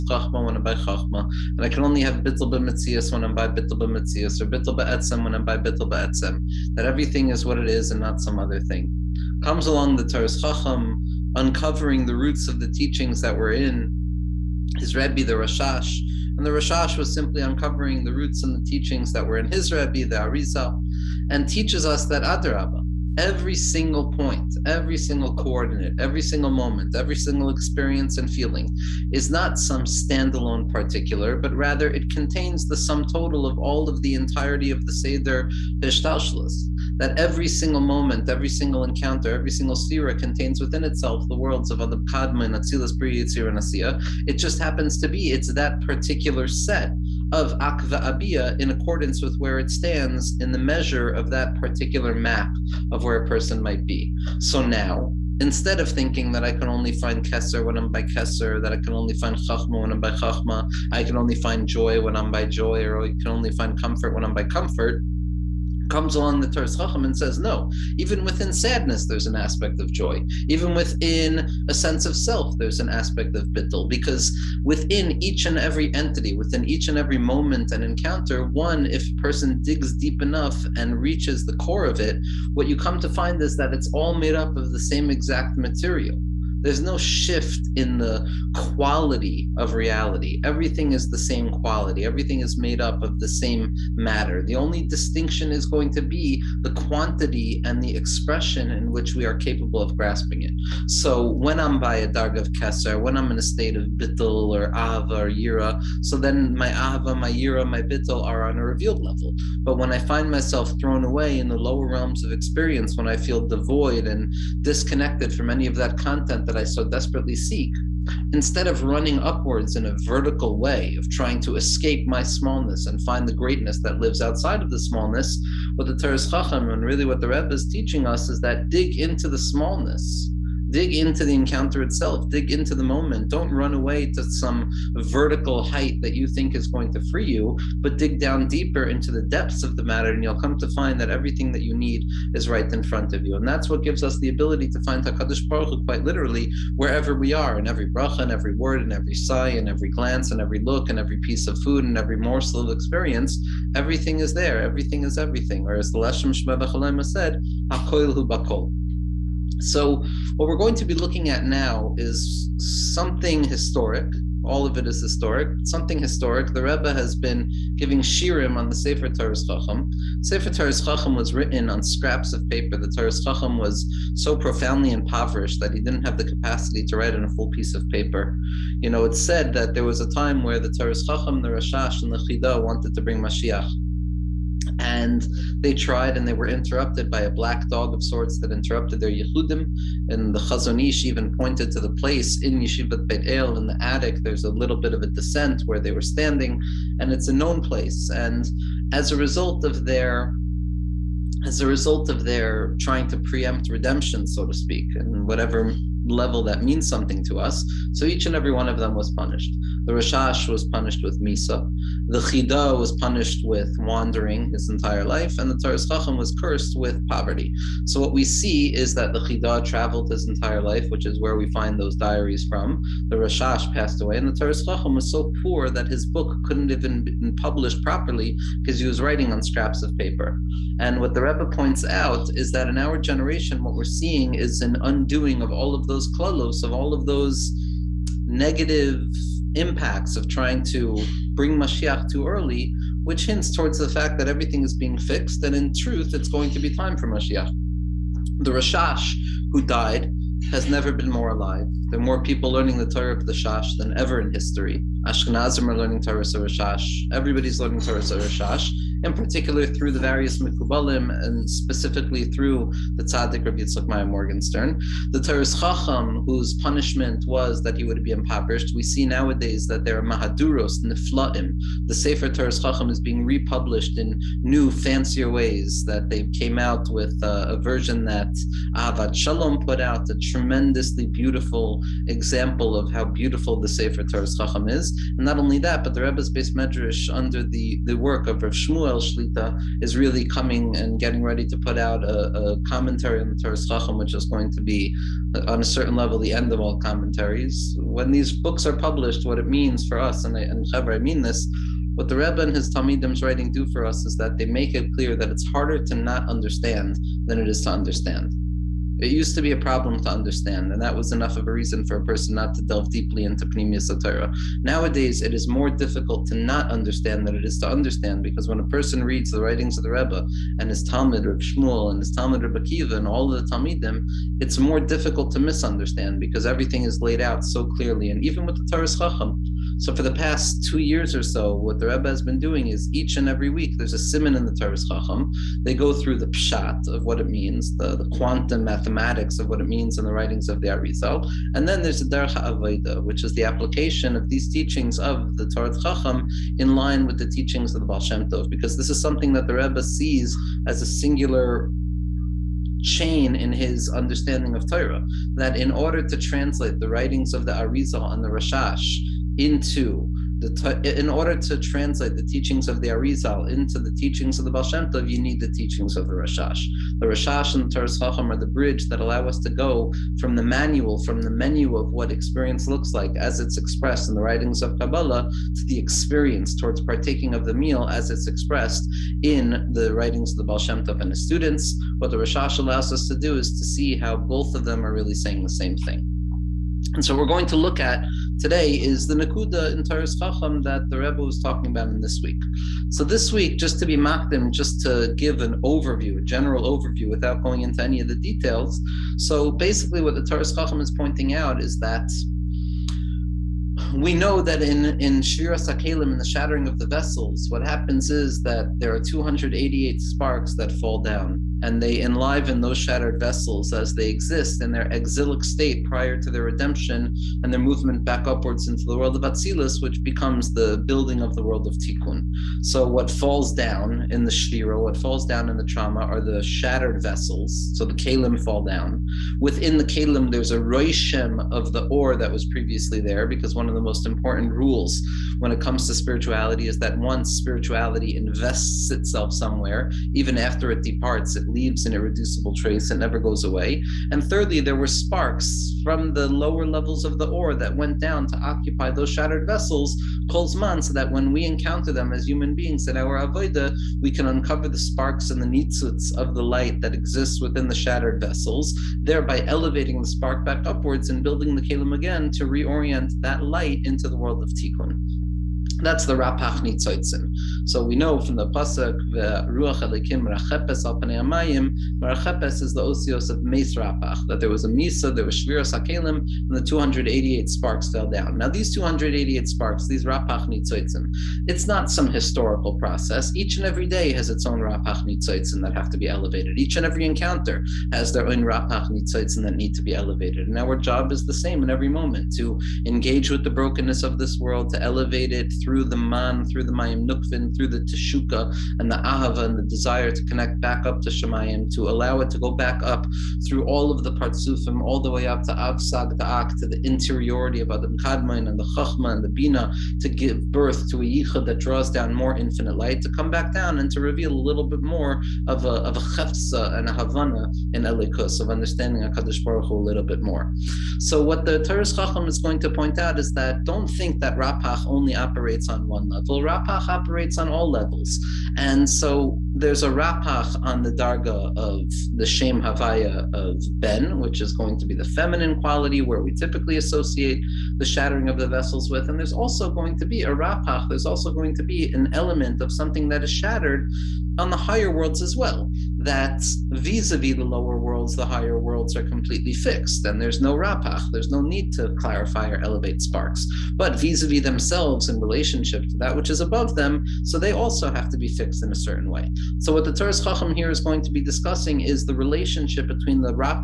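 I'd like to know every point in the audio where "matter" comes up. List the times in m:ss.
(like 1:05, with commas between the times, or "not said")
1:33, 2:19.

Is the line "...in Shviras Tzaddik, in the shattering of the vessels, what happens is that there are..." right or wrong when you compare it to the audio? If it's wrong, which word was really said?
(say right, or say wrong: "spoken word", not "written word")
wrong: "Hakelim", not "Tzaddik".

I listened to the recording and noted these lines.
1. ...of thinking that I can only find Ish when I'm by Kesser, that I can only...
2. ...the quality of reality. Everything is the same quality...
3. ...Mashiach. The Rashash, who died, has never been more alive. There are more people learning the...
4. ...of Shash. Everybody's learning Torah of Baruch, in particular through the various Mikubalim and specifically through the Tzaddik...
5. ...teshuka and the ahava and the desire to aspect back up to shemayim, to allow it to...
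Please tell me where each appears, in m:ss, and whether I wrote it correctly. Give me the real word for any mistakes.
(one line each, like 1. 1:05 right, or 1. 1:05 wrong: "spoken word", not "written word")
1. 0:55 wrong: "Kesser", not "Ish"
2. 1:27 right
3. 4:07 right
4. 4:16 wrong: "Shash", not "Baruch"
5. 8:17 wrong: "connect", not "aspect".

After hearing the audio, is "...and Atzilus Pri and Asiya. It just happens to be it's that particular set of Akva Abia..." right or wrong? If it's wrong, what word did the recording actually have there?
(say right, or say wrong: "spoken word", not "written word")
right.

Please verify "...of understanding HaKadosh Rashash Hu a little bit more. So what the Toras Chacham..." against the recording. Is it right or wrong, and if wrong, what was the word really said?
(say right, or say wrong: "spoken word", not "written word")
wrong: "Baruch", not "Rashash".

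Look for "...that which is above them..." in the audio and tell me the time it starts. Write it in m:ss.
9:15.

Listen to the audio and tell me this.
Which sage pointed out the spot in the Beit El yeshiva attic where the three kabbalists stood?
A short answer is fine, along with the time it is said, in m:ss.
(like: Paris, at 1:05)
Chazon Ish, at 3:10.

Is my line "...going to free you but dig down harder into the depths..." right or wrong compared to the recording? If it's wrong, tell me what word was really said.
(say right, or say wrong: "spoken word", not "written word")
wrong: "deeper", not "harder".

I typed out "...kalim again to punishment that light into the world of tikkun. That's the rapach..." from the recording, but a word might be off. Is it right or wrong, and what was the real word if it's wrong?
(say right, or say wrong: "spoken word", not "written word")
wrong: "reorient", not "punishment".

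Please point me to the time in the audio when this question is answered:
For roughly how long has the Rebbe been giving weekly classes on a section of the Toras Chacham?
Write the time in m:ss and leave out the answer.
5:30.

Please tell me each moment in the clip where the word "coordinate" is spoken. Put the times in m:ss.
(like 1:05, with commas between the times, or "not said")
0:25.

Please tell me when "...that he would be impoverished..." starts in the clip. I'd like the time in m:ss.
4:27.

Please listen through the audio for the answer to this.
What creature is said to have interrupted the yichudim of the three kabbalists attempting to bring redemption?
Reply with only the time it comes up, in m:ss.
3:07.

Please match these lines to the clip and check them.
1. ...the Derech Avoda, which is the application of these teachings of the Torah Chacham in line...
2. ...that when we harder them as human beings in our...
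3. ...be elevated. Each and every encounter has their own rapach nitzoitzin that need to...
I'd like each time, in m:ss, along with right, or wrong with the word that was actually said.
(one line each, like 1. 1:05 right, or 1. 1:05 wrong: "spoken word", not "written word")
1. 5:41 right
2. 7:30 wrong: "encounter", not "harder"
3. 8:05 right.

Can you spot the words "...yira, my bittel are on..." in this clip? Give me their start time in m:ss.
1:47.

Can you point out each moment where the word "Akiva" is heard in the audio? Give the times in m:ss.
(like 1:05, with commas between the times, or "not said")
5:22.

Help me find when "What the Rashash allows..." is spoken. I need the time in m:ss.
6:21.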